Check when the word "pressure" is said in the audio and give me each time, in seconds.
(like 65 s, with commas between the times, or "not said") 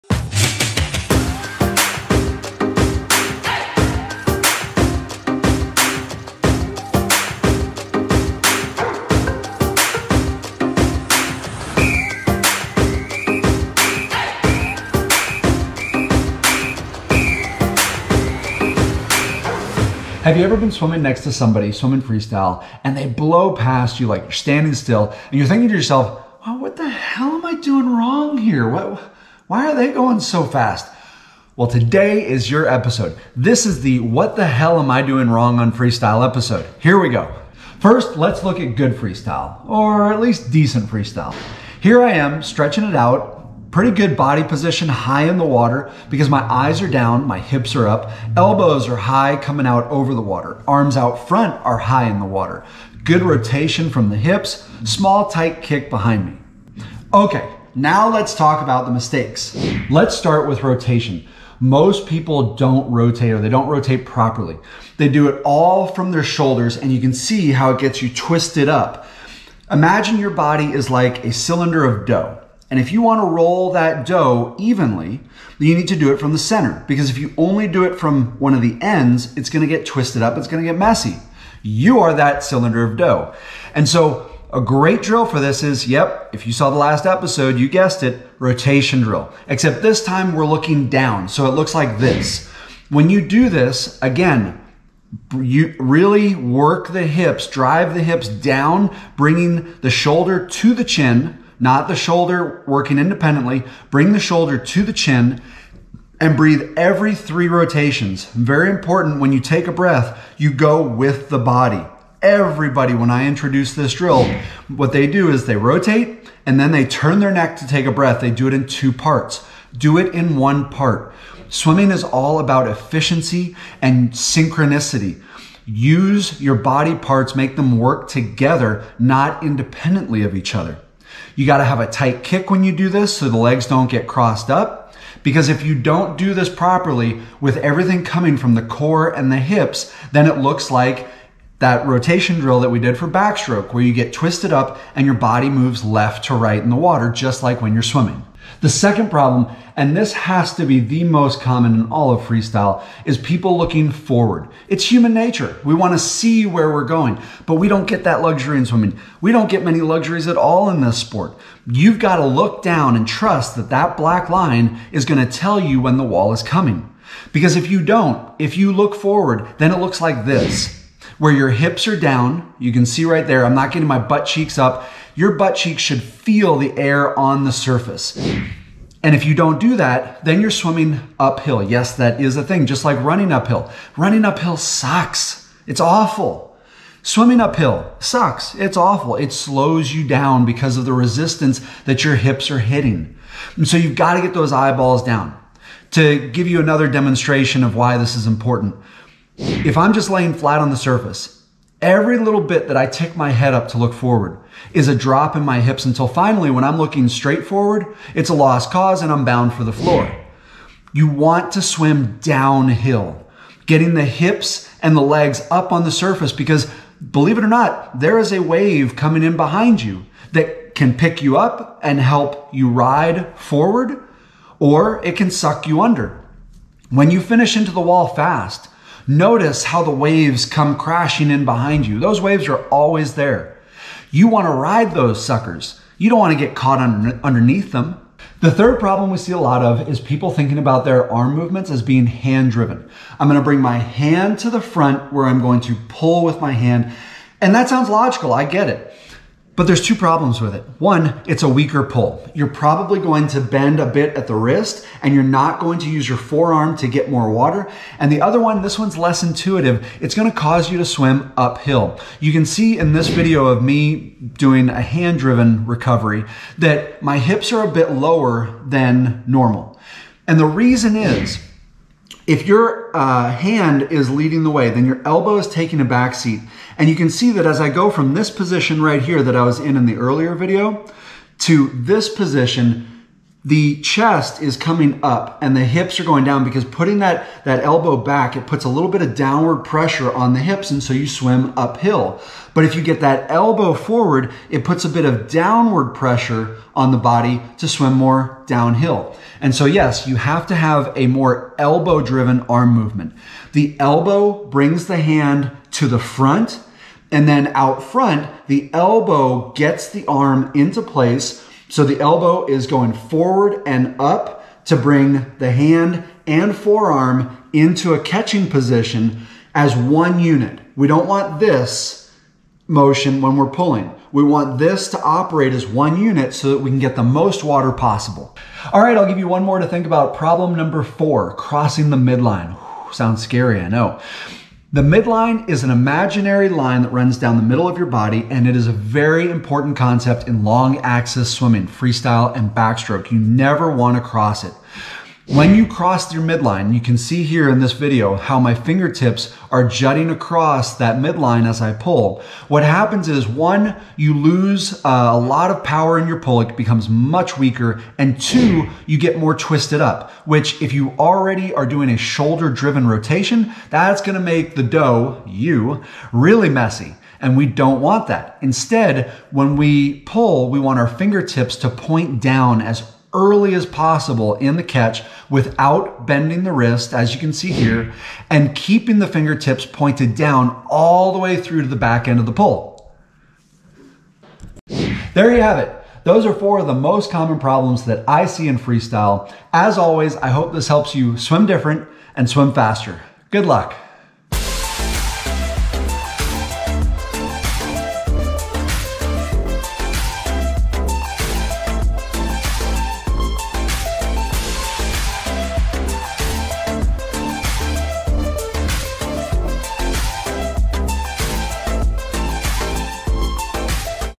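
289 s, 295 s.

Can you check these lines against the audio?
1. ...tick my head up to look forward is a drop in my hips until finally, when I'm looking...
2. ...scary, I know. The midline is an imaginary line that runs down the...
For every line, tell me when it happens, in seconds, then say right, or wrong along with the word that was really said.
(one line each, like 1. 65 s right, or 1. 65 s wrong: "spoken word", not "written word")
1. 202 s right
2. 333 s right.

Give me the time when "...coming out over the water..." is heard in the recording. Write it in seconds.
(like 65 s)
49 s.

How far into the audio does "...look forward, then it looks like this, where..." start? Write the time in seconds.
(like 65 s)
168 s.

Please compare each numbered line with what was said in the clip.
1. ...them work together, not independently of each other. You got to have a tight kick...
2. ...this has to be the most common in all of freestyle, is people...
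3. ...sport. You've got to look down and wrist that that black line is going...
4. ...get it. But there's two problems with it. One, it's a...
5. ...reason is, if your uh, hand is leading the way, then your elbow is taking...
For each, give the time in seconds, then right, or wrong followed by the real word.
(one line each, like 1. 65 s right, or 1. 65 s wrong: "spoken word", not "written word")
1. 127 s right
2. 149 s right
3. 160 s wrong: "trust", not "wrist"
4. 248 s right
5. 270 s right.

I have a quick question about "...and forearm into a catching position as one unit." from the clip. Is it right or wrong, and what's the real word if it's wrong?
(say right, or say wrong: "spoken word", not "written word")
right.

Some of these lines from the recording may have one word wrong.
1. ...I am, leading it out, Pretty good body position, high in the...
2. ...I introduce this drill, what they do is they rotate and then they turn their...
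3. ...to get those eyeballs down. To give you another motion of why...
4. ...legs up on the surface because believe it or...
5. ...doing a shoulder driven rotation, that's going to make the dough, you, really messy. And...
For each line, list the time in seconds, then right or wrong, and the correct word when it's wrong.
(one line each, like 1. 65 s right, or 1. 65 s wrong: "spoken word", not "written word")
1. 42 s wrong: "stretching", not "leading"
2. 113 s right
3. 194 s wrong: "demonstration", not "motion"
4. 215 s right
5. 361 s right.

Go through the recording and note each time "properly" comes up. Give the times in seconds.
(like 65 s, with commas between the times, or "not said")
64 s, 136 s.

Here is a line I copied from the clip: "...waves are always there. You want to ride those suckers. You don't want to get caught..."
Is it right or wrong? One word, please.
right.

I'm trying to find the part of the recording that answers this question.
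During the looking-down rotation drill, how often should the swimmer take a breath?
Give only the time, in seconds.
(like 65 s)
106 s.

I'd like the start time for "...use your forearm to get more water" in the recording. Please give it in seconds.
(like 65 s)
255 s.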